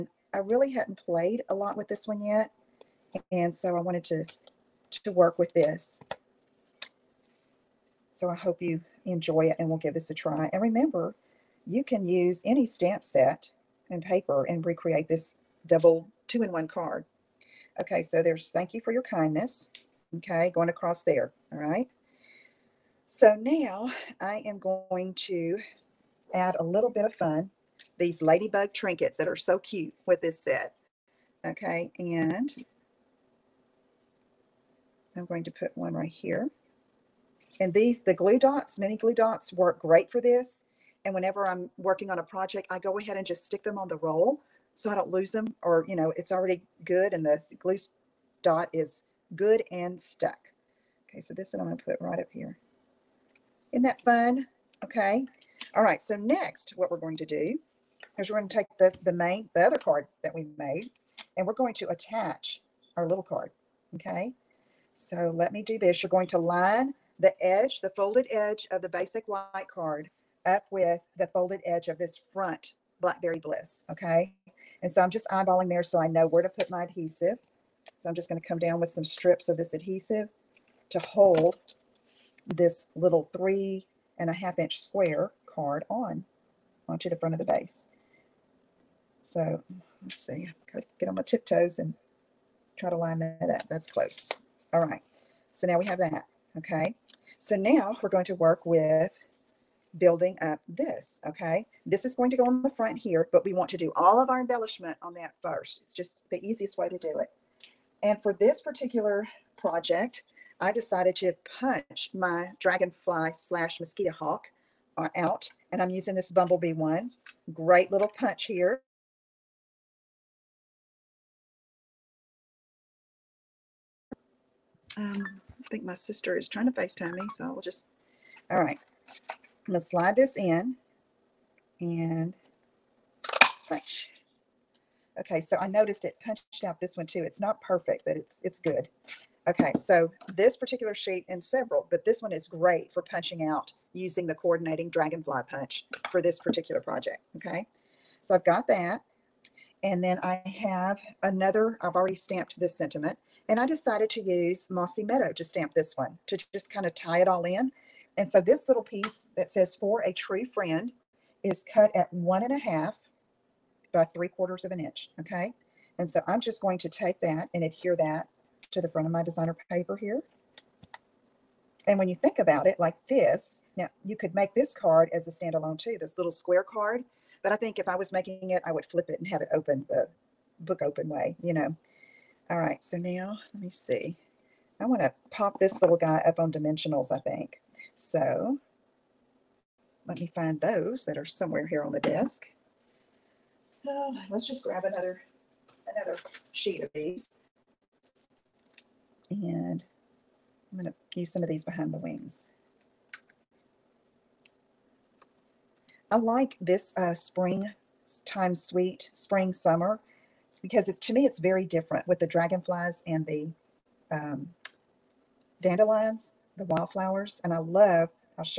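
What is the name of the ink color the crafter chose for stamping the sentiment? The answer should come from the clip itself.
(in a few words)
Mossy Meadow.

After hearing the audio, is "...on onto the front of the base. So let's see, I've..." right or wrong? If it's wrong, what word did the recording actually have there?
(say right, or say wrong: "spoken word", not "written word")
right.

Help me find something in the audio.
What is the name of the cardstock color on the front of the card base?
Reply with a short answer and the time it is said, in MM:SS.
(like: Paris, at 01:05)
Blackberry Bliss, at 01:12.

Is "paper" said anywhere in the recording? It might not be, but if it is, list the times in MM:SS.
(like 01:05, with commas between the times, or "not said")
00:14, 02:49.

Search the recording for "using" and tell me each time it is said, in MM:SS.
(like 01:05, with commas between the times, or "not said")
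01:55, 02:23.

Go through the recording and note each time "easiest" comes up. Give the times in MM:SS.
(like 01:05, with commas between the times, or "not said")
01:46.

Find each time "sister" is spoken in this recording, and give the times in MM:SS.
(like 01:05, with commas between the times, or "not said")
02:05.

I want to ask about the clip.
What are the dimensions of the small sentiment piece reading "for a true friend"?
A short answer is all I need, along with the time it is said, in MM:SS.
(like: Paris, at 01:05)
1 1/2 by 3/4 inch, at 02:42.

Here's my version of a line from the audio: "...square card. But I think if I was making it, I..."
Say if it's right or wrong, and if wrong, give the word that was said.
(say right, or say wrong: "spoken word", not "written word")
right.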